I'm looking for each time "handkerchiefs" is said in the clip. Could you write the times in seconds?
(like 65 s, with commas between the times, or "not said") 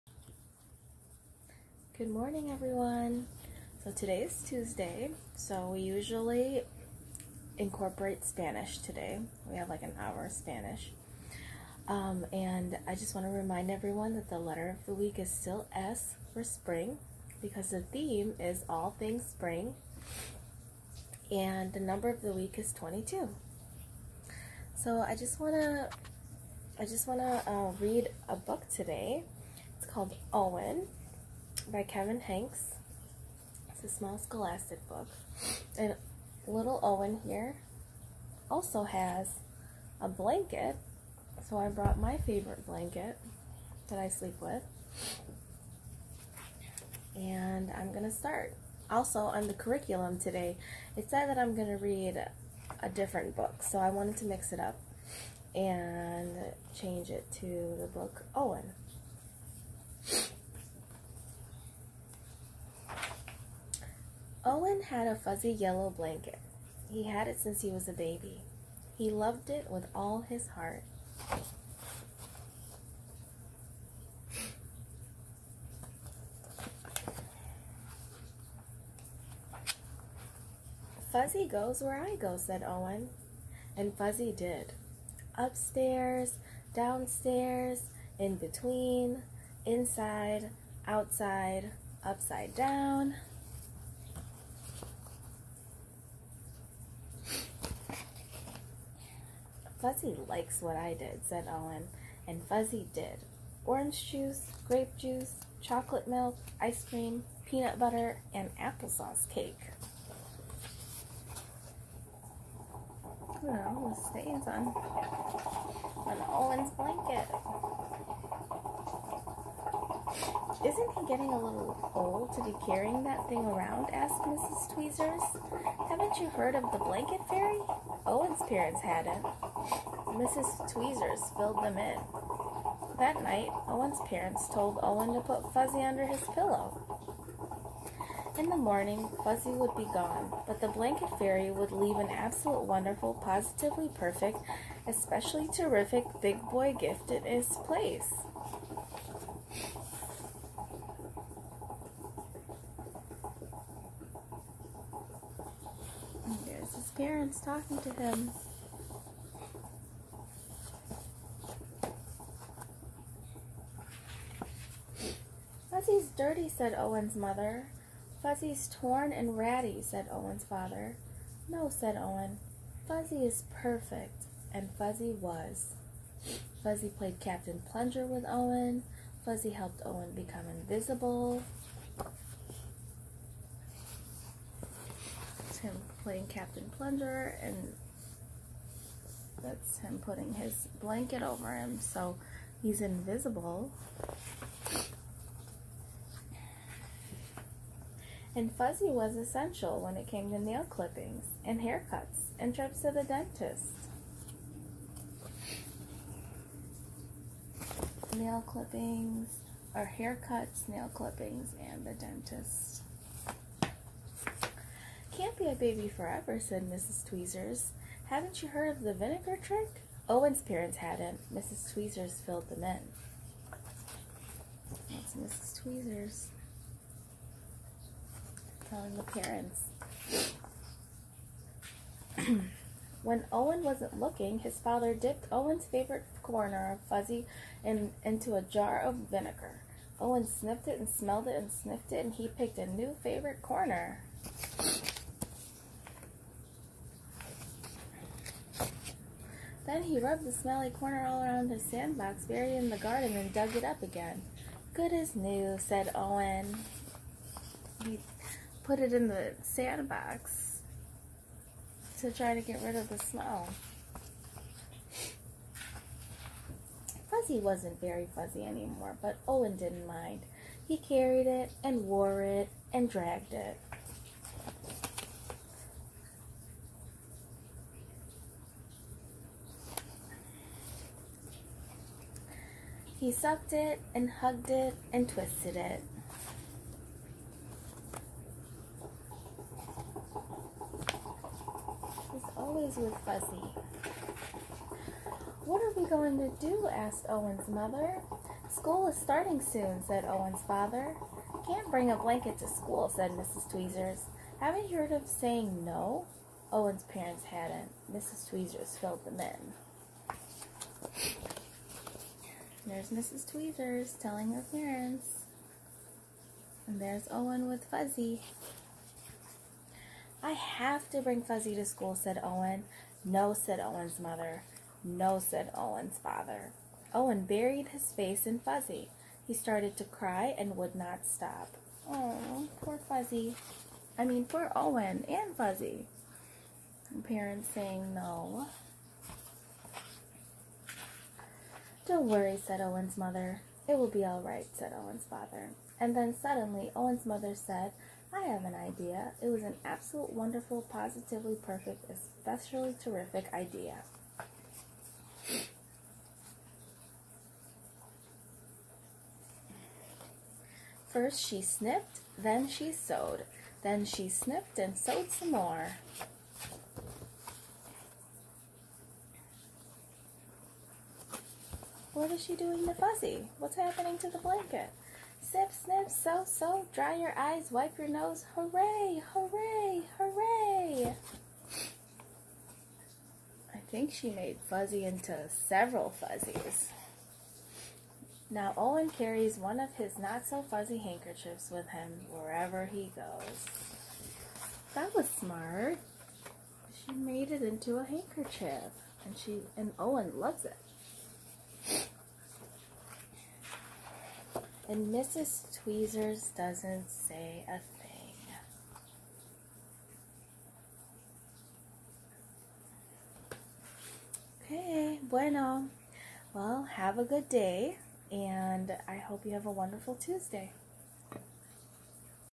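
390 s, 397 s.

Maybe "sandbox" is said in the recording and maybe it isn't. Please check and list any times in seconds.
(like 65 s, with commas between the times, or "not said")
251 s, 259 s.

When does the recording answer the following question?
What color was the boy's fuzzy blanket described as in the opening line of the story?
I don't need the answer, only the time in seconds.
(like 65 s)
65 s.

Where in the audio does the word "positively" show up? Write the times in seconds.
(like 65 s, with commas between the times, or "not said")
143 s, 350 s.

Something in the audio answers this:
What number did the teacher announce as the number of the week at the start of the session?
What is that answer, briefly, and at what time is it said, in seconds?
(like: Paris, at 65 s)
22, at 22 s.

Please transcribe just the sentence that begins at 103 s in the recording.
Orange juice, grape juice, chocolate milk, ice cream, peanut butter, and applesauce cake.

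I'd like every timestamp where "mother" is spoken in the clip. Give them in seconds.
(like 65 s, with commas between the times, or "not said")
167 s, 297 s, 323 s, 342 s, 347 s.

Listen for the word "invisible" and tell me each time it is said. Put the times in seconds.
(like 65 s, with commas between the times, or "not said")
180 s, 192 s.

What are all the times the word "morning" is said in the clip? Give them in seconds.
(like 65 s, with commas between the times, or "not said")
2 s, 138 s.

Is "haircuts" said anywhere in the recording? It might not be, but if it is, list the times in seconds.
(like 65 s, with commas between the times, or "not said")
201 s, 209 s.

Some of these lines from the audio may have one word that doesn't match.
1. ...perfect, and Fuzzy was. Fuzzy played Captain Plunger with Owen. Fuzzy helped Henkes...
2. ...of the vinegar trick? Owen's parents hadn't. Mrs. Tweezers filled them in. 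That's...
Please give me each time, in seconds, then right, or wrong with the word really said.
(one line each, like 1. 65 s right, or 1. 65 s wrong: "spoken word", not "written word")
1. 173 s wrong: "Owen", not "Henkes"
2. 218 s right.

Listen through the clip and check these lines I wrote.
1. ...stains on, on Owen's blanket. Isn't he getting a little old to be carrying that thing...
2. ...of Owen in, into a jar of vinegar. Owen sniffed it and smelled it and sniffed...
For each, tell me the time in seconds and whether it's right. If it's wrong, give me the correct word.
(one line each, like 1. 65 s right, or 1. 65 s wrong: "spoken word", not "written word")
1. 114 s right
2. 236 s wrong: "Fuzzy", not "Owen".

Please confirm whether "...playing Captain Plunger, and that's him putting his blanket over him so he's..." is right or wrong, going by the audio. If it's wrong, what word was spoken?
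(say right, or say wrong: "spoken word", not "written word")
right.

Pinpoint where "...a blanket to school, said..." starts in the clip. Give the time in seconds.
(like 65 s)
301 s.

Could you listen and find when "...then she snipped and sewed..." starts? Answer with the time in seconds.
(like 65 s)
363 s.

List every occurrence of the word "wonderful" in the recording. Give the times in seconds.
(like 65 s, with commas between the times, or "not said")
142 s, 350 s, 419 s.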